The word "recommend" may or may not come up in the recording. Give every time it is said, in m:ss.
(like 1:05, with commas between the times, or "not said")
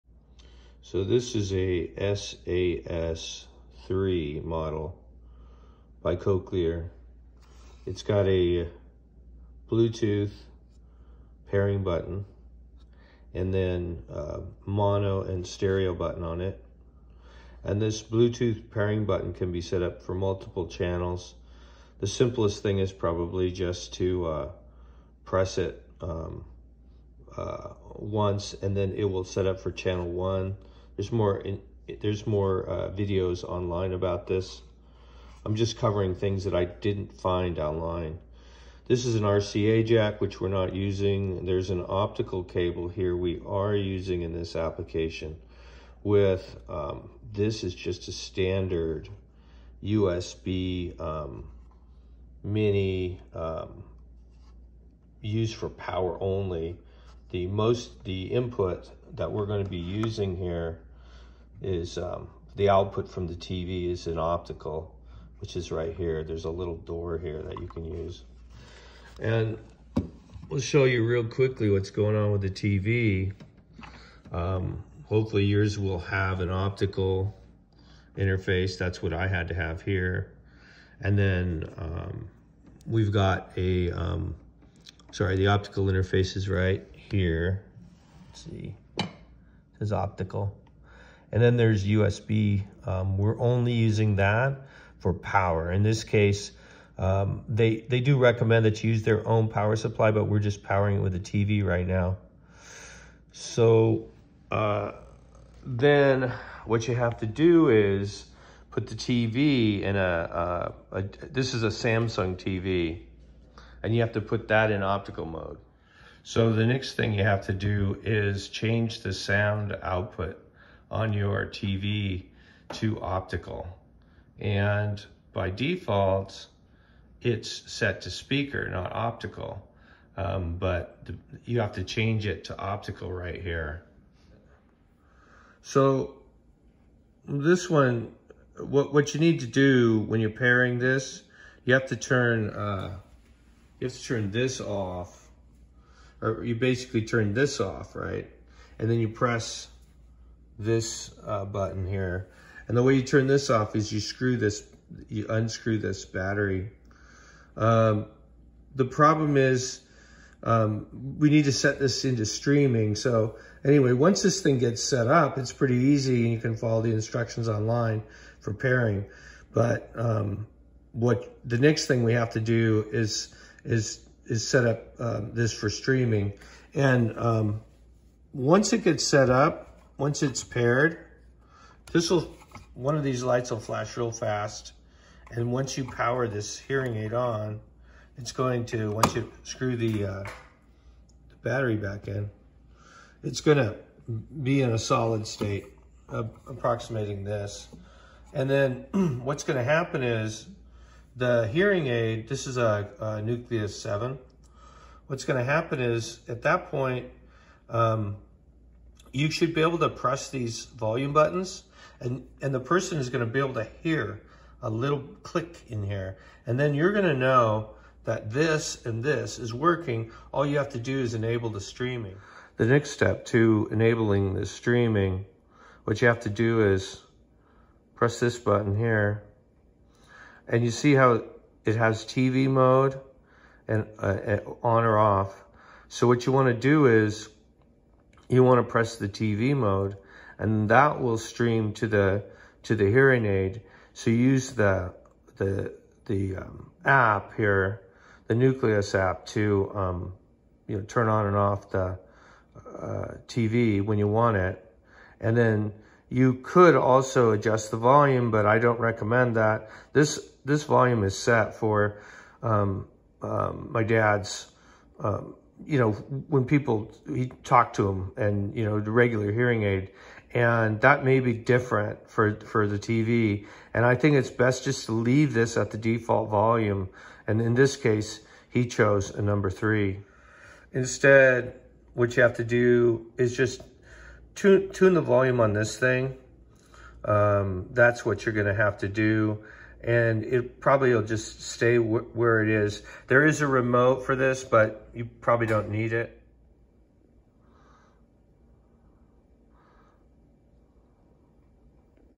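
1:38, 4:18.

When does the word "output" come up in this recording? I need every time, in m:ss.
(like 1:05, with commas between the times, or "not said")
1:02, 1:59.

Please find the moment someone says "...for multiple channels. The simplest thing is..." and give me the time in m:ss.
0:20.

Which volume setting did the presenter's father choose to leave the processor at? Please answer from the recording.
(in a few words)
3.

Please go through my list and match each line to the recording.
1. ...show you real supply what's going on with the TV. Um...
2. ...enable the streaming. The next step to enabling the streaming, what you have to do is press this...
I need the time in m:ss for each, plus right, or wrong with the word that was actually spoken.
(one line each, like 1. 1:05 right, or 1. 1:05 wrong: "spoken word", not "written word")
1. 1:10 wrong: "quickly", not "supply"
2. 3:41 right.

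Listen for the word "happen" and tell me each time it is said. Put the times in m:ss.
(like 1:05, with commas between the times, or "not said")
3:19, 3:25.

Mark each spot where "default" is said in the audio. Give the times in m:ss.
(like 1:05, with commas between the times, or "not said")
2:05, 4:35.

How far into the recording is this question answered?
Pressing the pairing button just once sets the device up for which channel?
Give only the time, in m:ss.
0:29.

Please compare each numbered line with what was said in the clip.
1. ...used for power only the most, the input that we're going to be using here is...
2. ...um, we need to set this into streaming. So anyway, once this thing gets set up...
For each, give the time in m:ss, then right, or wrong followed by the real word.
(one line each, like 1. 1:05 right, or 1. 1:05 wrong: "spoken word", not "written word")
1. 0:55 right
2. 2:40 right.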